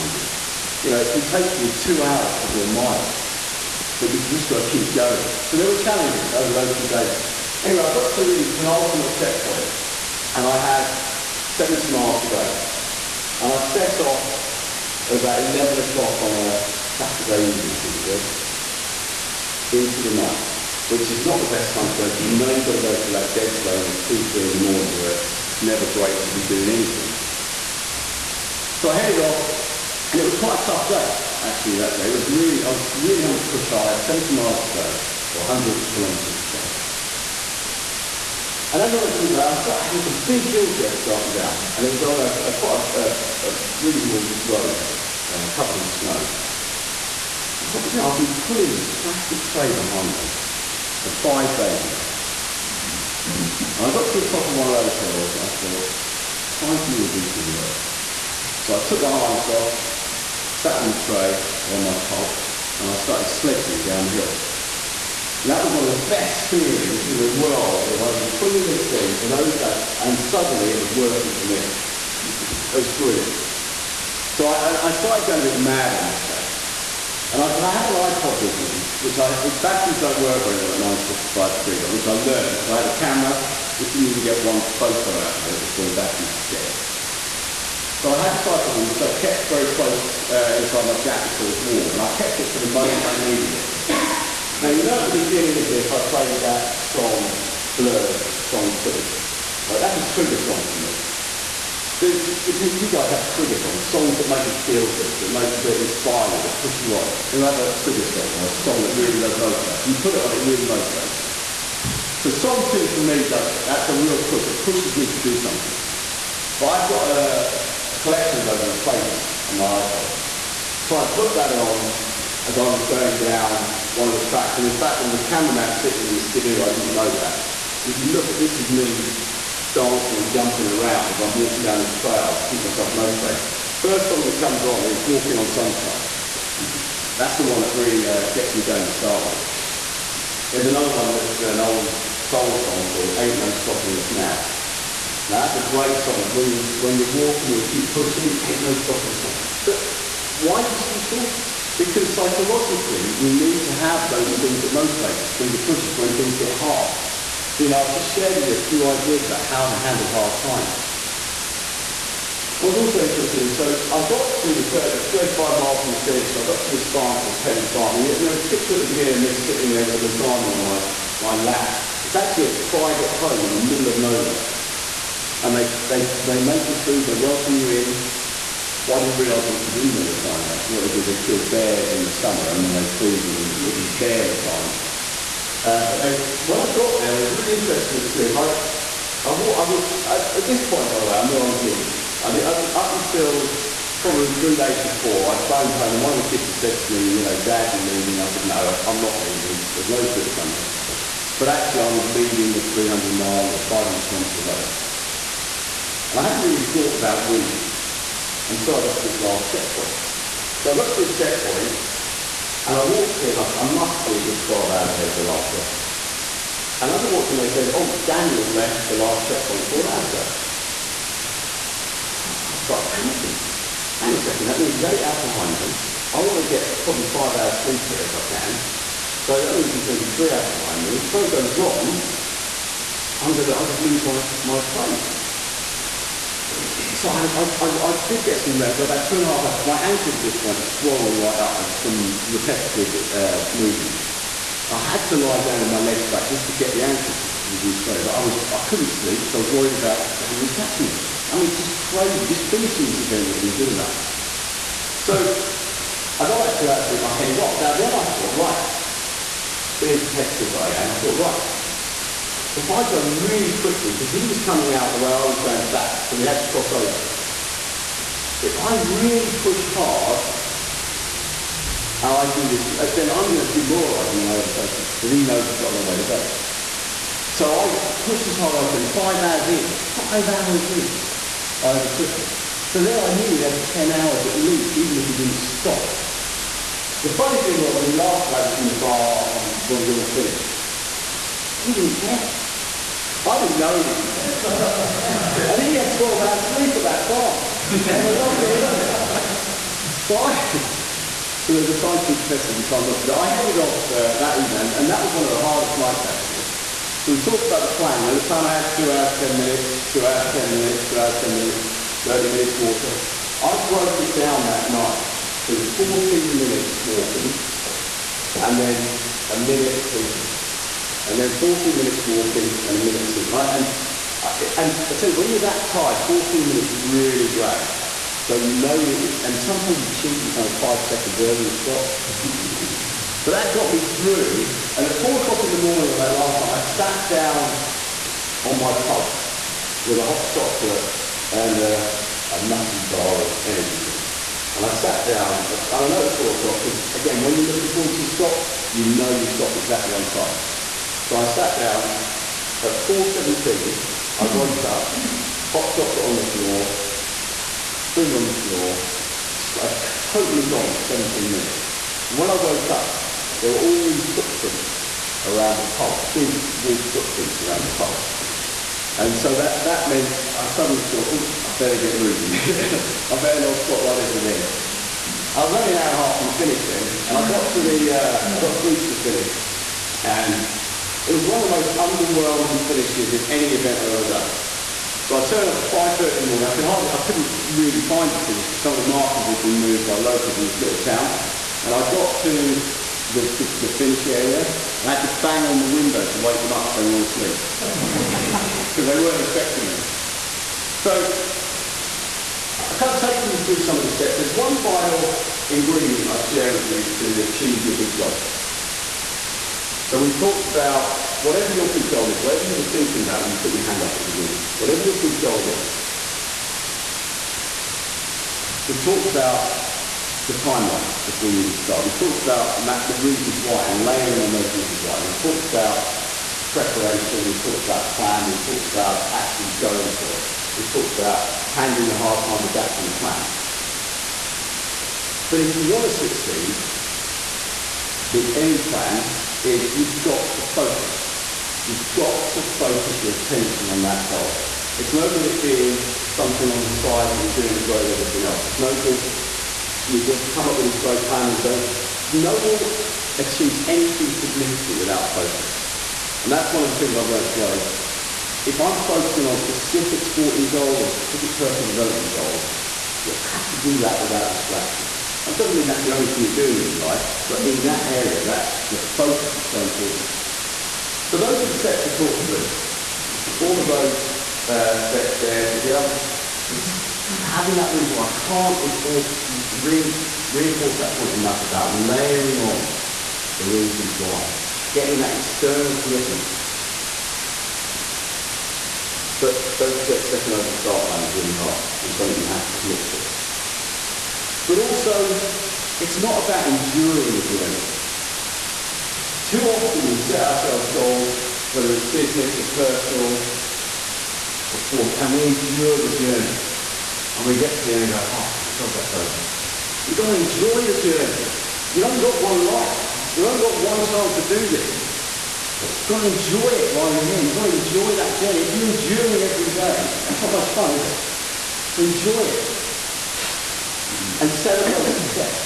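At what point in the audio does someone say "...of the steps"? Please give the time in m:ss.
6:43.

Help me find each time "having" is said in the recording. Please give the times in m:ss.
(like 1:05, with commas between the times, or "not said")
0:33, 0:39, 7:57.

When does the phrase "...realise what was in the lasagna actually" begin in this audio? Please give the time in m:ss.
2:59.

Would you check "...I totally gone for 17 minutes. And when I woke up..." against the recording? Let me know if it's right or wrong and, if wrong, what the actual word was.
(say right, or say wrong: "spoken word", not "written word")
right.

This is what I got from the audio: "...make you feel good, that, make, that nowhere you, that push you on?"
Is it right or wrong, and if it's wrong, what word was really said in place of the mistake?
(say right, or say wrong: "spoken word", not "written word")
wrong: "inspire", not "nowhere".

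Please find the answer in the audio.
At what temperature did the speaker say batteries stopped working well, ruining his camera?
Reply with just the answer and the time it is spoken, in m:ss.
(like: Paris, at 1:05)
minus 55 degrees, at 1:20.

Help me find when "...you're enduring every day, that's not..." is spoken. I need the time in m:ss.
8:38.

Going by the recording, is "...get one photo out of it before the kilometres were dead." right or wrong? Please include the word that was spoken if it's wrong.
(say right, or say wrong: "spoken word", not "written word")
wrong: "batteries", not "kilometres".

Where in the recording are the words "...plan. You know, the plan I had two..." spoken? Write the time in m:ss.
5:07.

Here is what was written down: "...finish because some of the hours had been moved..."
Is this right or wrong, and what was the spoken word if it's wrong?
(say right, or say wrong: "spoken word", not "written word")
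wrong: "markers", not "hours".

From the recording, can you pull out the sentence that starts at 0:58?
So I took my harness off, sat on the tray on my pulk, and I started sledging down the hills.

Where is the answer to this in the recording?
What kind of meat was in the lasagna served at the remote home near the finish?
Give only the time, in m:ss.
3:03.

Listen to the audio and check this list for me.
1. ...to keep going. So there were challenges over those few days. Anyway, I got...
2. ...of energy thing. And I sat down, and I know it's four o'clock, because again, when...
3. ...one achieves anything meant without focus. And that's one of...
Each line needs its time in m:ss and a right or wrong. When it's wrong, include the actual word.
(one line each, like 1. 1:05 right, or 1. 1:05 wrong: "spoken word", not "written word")
1. 0:04 right
2. 5:43 right
3. 7:32 wrong: "significant", not "meant".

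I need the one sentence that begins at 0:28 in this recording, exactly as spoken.
So I headed off and it was quite a tough day, actually, that day.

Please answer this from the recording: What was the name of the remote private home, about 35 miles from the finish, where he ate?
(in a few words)
Pelly Farm.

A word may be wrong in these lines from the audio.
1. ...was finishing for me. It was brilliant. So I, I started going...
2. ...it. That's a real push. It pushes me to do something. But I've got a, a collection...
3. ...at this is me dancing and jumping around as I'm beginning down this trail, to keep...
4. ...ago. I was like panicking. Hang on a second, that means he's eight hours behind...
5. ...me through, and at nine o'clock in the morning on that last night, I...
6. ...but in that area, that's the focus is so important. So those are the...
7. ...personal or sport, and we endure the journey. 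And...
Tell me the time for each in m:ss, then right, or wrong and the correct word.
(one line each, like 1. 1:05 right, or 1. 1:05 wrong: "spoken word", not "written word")
1. 1:10 wrong: "working", not "finishing"
2. 1:53 right
3. 2:08 wrong: "walking", not "beginning"
4. 3:40 right
5. 5:33 wrong: "four", not "nine"
6. 7:47 right
7. 8:22 right.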